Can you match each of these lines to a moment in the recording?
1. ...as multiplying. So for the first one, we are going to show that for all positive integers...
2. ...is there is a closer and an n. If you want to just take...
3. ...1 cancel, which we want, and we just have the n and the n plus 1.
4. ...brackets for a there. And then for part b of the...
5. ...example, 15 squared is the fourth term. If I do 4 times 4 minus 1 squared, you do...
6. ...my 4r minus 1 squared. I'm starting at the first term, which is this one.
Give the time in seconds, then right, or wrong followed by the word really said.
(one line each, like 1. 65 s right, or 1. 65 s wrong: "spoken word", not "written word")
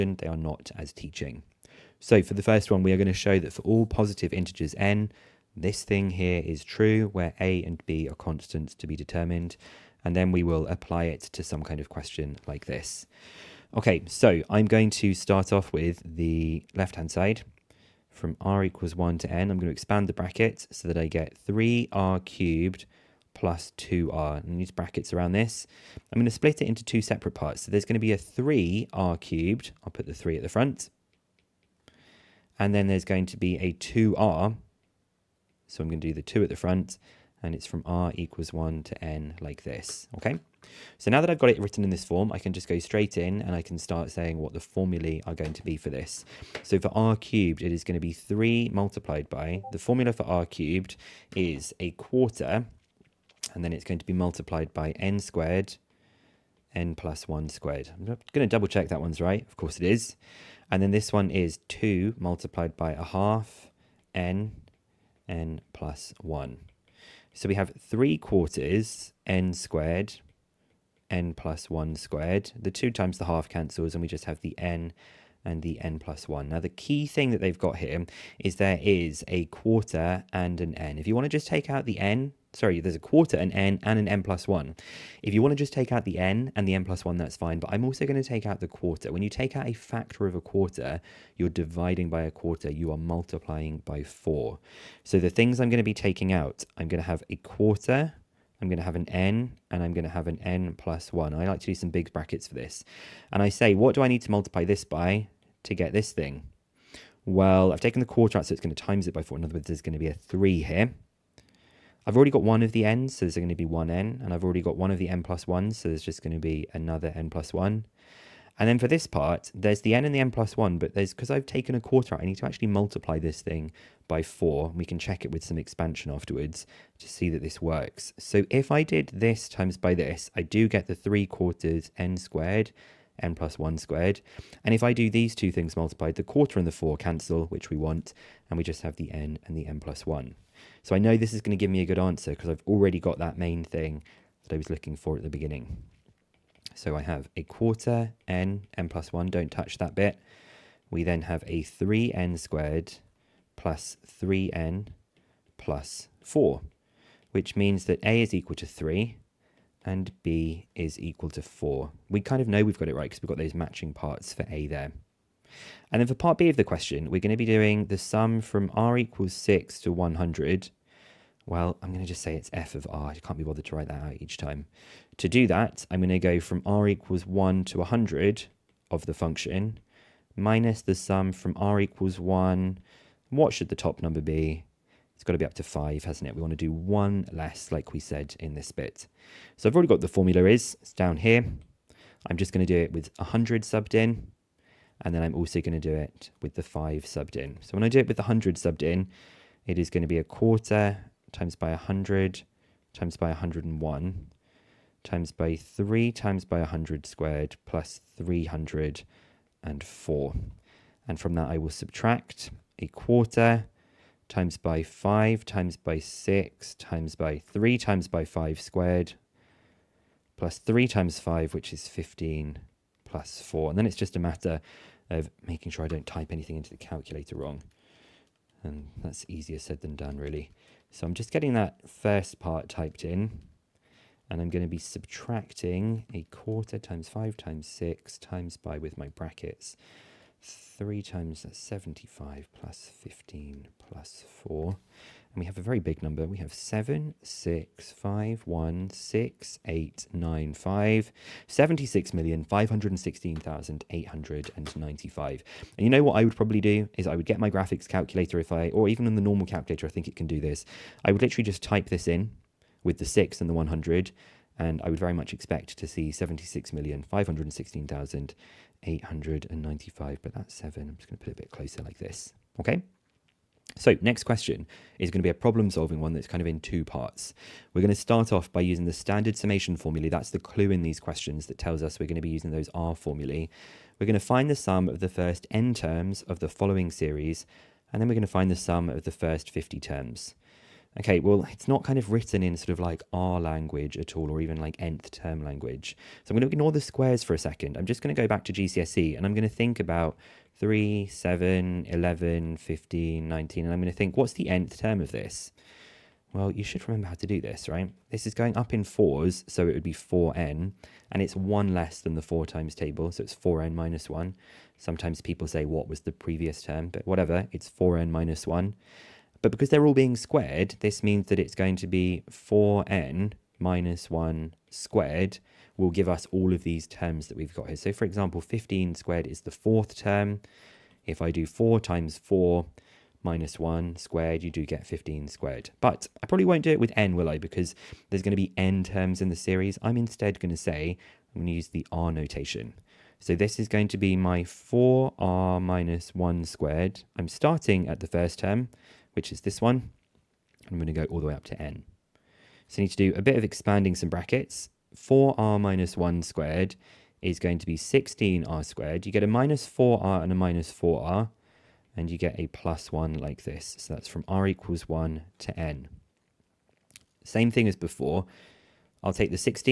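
1. 0 s wrong: "teaching", not "multiplying"
2. 78 s wrong: "quarter", not "closer"
3. 136 s wrong: "4", not "1"
4. 163 s wrong: "parts", not "brackets"
5. 328 s right
6. 344 s right.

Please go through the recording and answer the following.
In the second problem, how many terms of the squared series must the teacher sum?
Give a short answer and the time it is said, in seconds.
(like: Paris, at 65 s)
50, at 289 s.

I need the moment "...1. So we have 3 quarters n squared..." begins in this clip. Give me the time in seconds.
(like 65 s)
66 s.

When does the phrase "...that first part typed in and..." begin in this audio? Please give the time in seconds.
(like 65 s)
231 s.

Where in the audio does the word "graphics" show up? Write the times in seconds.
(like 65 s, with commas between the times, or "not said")
257 s.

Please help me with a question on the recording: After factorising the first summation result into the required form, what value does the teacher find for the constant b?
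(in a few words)
4.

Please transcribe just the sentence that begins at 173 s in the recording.
I can't be bothered to write that out each time.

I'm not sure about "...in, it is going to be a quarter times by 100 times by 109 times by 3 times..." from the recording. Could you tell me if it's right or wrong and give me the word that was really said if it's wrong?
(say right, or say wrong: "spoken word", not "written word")
wrong: "101", not "109".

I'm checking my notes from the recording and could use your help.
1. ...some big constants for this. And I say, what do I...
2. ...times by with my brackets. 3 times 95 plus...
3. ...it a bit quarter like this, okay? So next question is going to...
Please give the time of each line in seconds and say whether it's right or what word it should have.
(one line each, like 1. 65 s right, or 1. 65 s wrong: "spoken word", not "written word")
1. 101 s wrong: "brackets", not "constants"
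2. 238 s wrong: "75", not "95"
3. 271 s wrong: "closer", not "quarter".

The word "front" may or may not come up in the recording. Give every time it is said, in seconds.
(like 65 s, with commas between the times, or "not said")
30 s, 36 s.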